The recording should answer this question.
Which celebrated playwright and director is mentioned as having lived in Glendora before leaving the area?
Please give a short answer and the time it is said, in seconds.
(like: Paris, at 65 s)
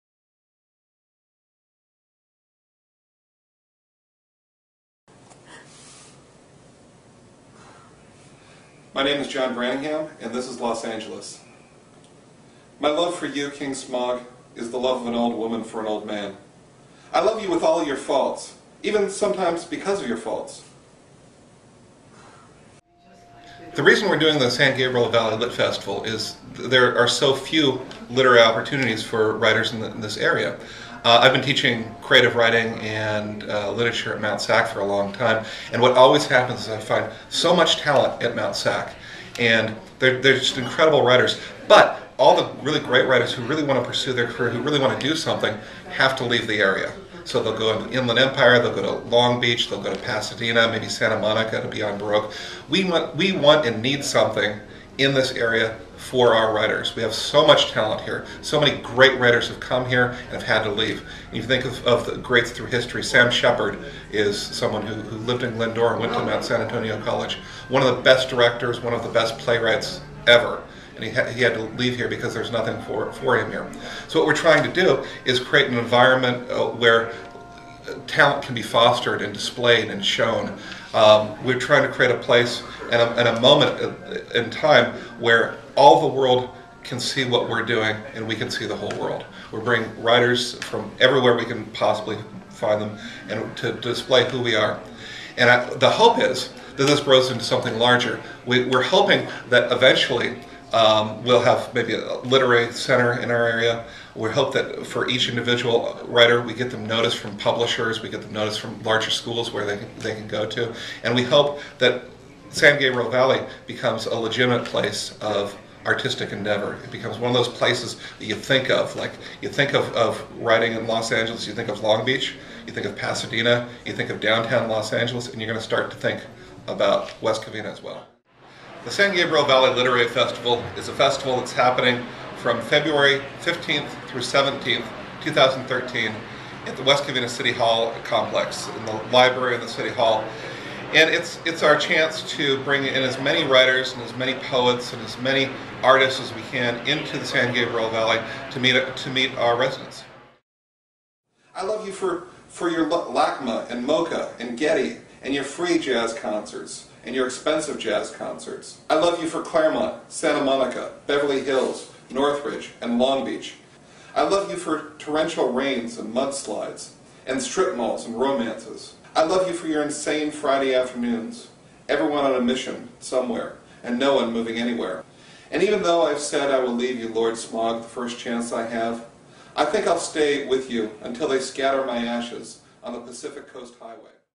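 Sam Shepard, at 63 s.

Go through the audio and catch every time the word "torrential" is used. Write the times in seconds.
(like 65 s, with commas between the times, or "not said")
164 s.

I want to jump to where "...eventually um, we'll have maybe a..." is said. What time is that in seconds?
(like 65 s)
99 s.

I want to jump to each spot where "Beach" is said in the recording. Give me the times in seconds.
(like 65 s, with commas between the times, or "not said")
49 s, 122 s, 163 s.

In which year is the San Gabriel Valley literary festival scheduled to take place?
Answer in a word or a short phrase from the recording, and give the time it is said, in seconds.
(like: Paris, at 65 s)
2013, at 135 s.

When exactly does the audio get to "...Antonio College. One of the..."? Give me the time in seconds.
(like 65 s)
66 s.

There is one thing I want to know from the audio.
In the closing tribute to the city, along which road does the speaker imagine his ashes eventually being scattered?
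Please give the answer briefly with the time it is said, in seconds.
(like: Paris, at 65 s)
Pacific Coast Highway, at 183 s.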